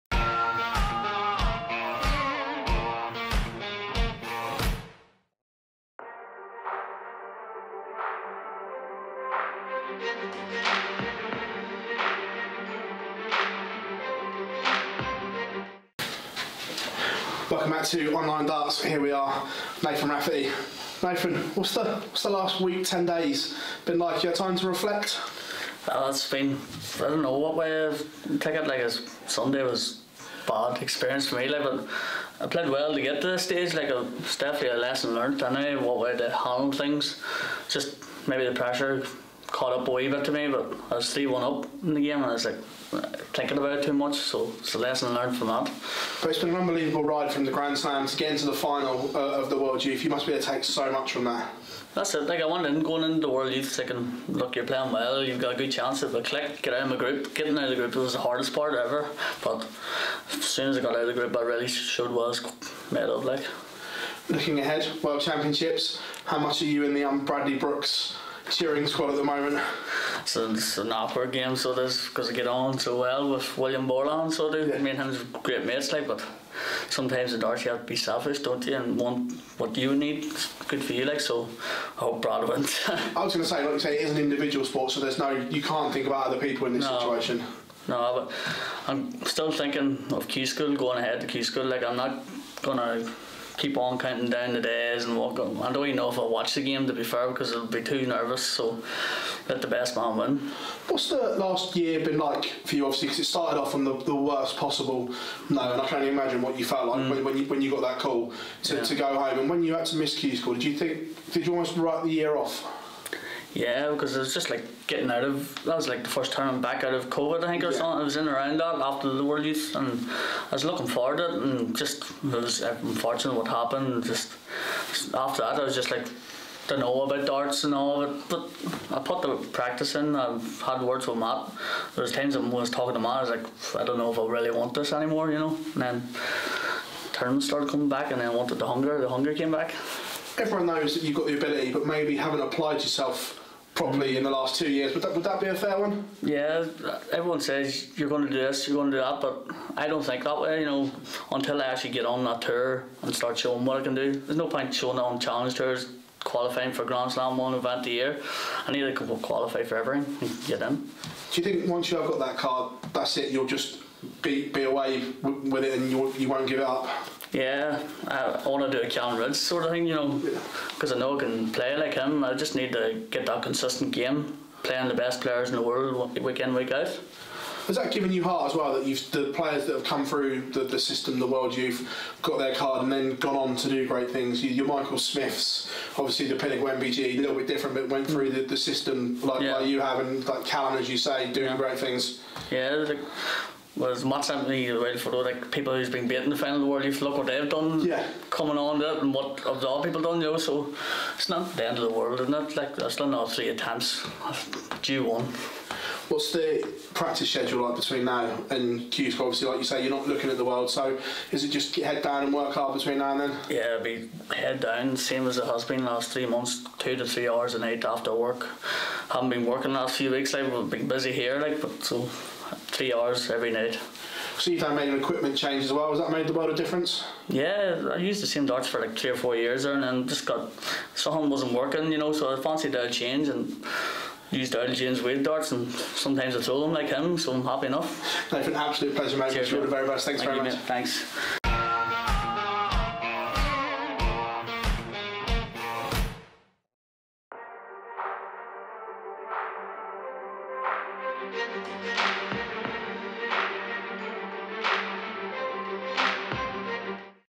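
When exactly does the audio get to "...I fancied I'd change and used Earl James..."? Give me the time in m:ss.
3:52.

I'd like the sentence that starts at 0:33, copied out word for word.
Like a, it's definitely a lesson learned.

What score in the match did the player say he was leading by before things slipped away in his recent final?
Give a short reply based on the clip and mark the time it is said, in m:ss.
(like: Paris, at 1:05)
3-1, at 0:41.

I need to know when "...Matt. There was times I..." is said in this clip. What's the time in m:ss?
2:11.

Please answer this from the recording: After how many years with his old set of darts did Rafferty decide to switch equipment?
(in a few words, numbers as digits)
3 or 4 years.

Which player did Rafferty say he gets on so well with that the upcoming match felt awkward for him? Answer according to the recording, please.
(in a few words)
William Borland.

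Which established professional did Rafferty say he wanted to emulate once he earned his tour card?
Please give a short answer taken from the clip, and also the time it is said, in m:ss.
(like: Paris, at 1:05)
Callan Rydz, at 2:48.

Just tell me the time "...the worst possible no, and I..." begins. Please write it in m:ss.
1:44.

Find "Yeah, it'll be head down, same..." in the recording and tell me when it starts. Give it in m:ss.
3:33.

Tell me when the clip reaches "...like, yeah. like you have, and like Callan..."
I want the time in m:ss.
3:09.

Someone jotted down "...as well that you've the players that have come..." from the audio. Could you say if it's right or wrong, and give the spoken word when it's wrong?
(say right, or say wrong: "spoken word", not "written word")
right.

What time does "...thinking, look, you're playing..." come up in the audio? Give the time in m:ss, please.
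0:53.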